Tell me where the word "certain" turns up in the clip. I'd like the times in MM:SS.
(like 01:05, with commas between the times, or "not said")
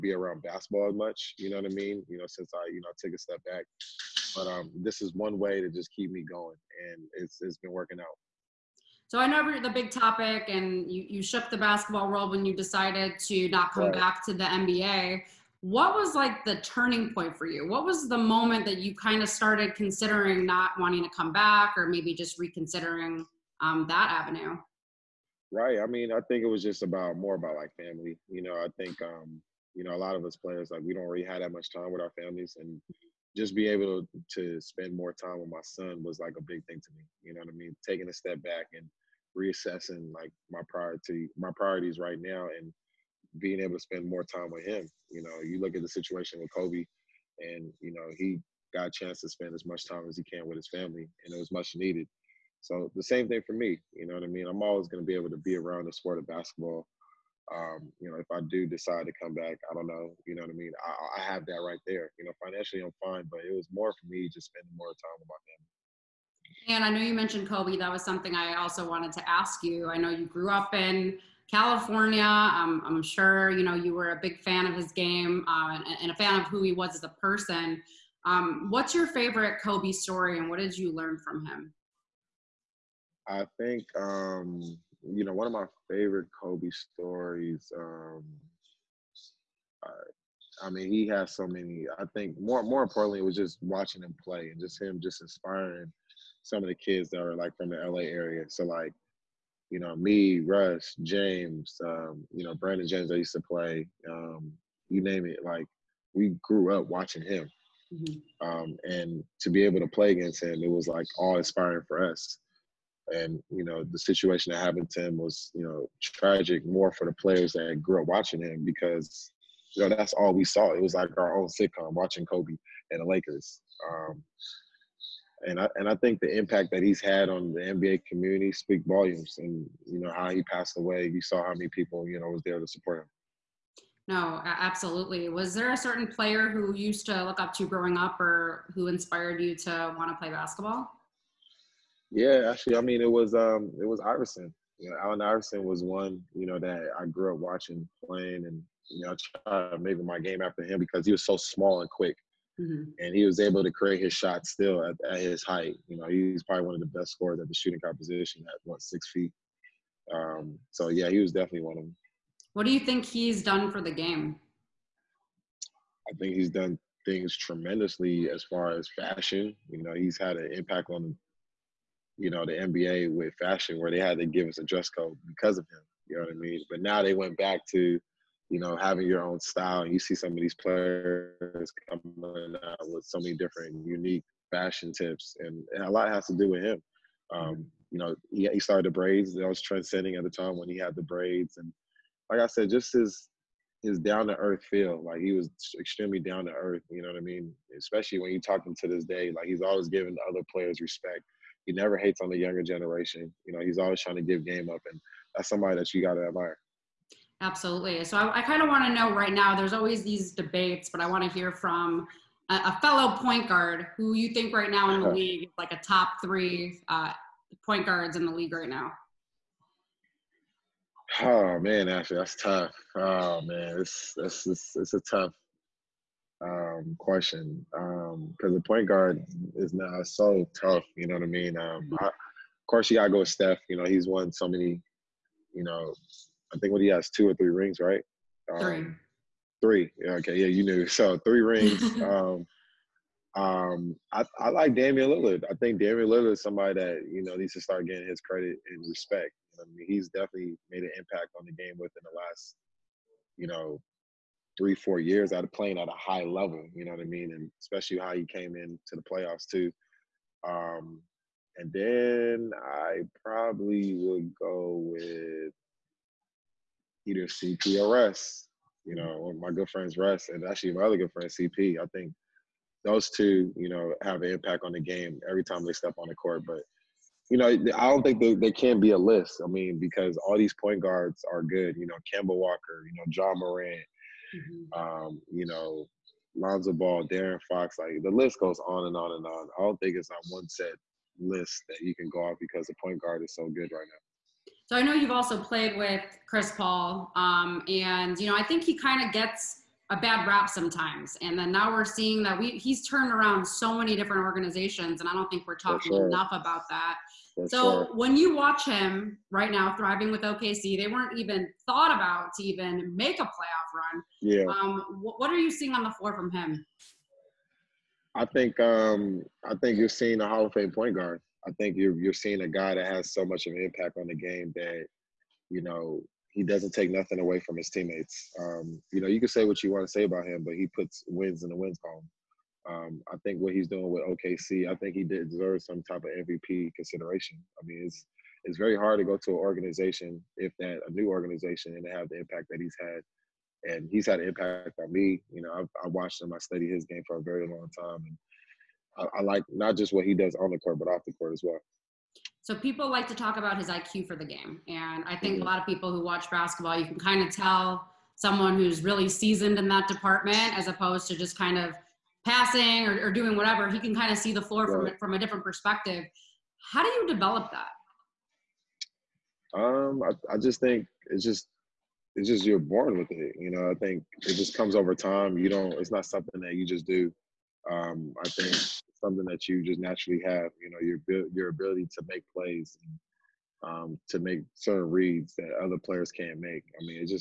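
02:15, 06:24.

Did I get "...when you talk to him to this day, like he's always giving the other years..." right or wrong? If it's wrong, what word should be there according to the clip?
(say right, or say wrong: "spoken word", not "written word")
wrong: "players", not "years".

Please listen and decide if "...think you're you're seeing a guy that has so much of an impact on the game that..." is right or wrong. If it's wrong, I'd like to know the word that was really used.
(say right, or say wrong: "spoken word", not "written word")
right.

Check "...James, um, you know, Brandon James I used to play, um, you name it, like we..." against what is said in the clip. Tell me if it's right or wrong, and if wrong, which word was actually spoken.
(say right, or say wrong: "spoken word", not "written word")
right.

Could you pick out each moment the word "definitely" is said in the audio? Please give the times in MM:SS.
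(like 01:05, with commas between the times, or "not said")
02:41, 04:10.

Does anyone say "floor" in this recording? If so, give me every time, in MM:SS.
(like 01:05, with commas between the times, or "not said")
05:15, 06:04.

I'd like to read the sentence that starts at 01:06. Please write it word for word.
And I know you mentioned Kobe.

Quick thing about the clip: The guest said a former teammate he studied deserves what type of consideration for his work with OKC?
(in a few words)
MVP consideration.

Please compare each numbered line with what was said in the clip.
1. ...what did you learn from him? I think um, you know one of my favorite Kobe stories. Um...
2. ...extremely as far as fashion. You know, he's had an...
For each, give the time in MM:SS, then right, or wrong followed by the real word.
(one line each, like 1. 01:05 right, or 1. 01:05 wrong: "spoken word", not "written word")
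1. 01:20 right
2. 02:47 wrong: "tremendously", not "extremely".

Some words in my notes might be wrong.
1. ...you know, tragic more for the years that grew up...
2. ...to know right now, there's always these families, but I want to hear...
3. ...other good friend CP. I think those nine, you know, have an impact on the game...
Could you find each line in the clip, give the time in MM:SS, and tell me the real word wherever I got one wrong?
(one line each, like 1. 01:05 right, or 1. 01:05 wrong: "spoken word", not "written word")
1. 01:55 wrong: "players", not "years"
2. 03:28 wrong: "debates", not "families"
3. 04:30 wrong: "two", not "nine".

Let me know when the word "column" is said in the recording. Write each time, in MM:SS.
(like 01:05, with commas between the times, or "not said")
05:31.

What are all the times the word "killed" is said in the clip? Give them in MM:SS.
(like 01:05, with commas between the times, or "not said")
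not said.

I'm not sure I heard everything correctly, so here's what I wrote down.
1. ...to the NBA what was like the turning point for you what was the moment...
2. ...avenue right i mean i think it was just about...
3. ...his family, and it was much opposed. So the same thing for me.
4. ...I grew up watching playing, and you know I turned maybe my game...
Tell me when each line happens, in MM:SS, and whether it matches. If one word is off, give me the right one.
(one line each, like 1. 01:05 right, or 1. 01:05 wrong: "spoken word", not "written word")
1. 00:14 right
2. 00:24 right
3. 00:50 wrong: "needed", not "opposed"
4. 02:26 wrong: "tried", not "turned".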